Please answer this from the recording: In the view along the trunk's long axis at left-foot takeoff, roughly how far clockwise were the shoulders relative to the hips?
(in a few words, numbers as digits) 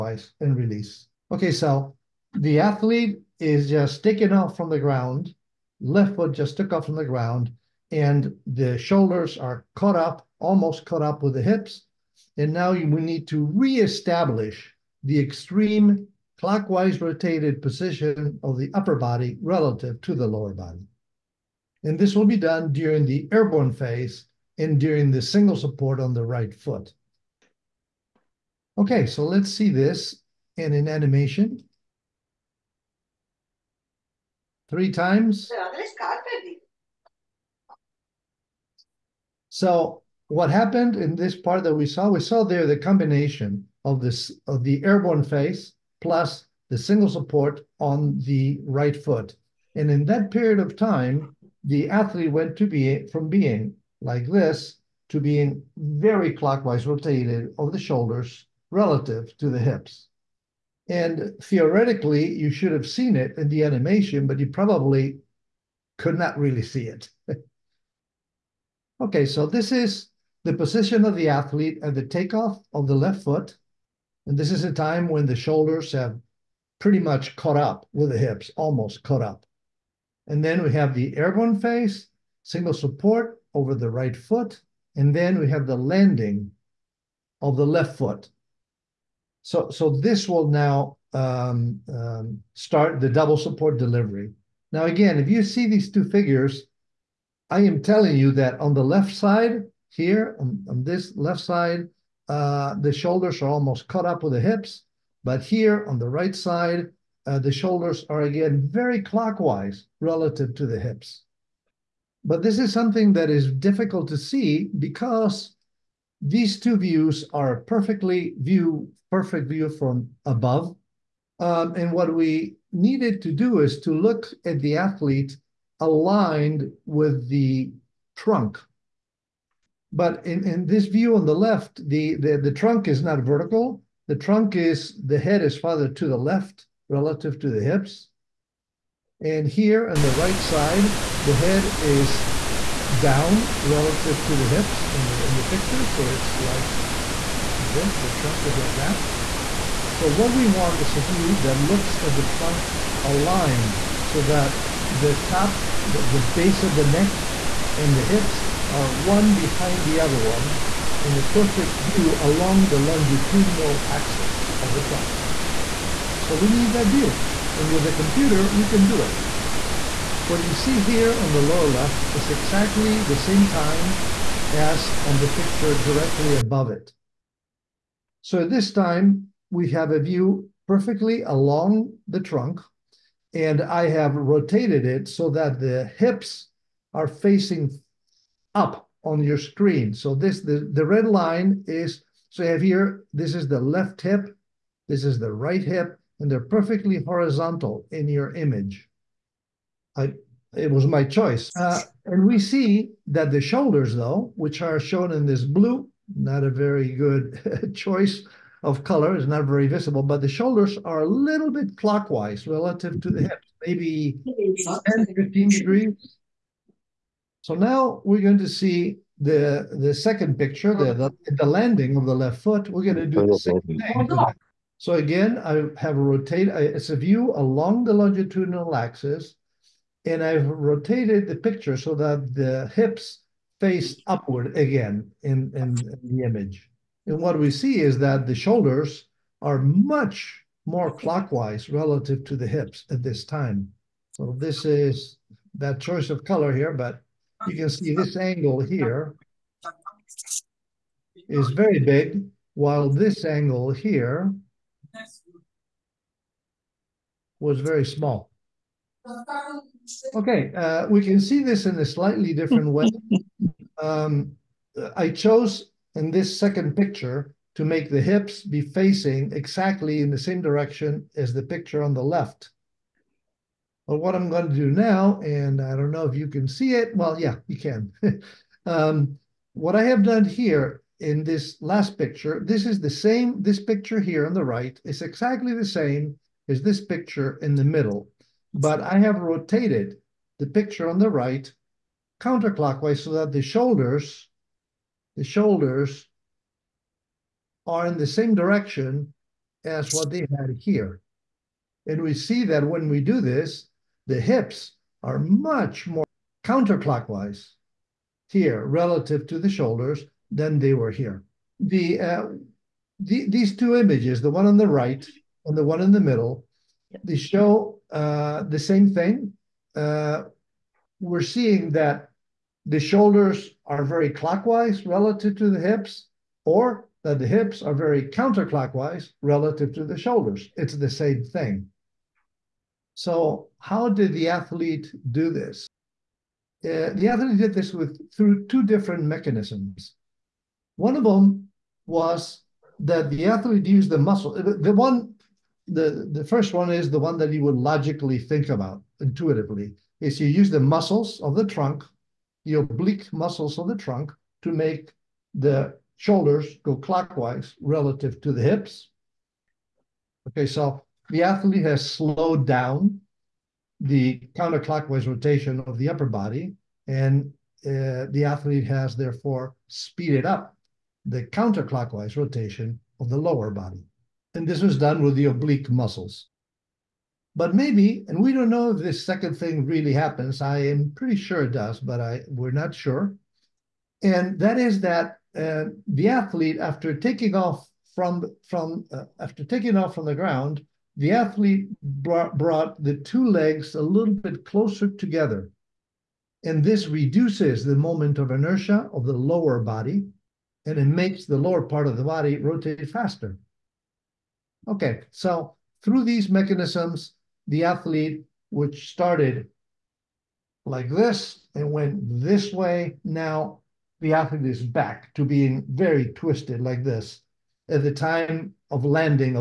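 10 to 15 degrees.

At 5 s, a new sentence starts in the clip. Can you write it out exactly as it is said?
Left foot just took off from the ground, and the shoulders are caught up, almost caught up with the hips.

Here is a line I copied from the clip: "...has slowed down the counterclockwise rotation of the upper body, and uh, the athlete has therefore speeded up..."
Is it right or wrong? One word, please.
right.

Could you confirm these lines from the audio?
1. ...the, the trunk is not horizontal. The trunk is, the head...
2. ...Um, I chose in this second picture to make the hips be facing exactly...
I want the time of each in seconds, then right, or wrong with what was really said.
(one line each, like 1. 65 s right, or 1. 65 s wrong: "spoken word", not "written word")
1. 132 s wrong: "vertical", not "horizontal"
2. 263 s right.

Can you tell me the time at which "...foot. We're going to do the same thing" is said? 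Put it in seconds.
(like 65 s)
222 s.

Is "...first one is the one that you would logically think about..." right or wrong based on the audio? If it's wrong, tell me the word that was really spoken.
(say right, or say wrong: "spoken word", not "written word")
right.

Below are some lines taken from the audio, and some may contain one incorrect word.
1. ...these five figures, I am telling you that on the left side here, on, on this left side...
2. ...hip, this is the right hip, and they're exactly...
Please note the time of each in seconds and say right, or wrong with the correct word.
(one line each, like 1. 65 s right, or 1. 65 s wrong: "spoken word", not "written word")
1. 95 s wrong: "two", not "five"
2. 194 s wrong: "perfectly", not "exactly".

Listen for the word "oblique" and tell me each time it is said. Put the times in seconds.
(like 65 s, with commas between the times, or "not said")
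352 s, 375 s.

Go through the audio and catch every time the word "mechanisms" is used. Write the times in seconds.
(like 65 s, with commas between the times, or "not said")
339 s, 406 s.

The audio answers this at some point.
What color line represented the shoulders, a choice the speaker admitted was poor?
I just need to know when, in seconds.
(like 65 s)
205 s.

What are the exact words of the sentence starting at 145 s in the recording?
So it's like this, the trunk is like that.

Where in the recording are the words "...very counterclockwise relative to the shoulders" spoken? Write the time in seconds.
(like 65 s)
327 s.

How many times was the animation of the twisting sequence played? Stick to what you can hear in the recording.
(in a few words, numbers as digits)
3.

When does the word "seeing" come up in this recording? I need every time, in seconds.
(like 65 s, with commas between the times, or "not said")
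321 s.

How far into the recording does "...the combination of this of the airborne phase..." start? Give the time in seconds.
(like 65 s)
42 s.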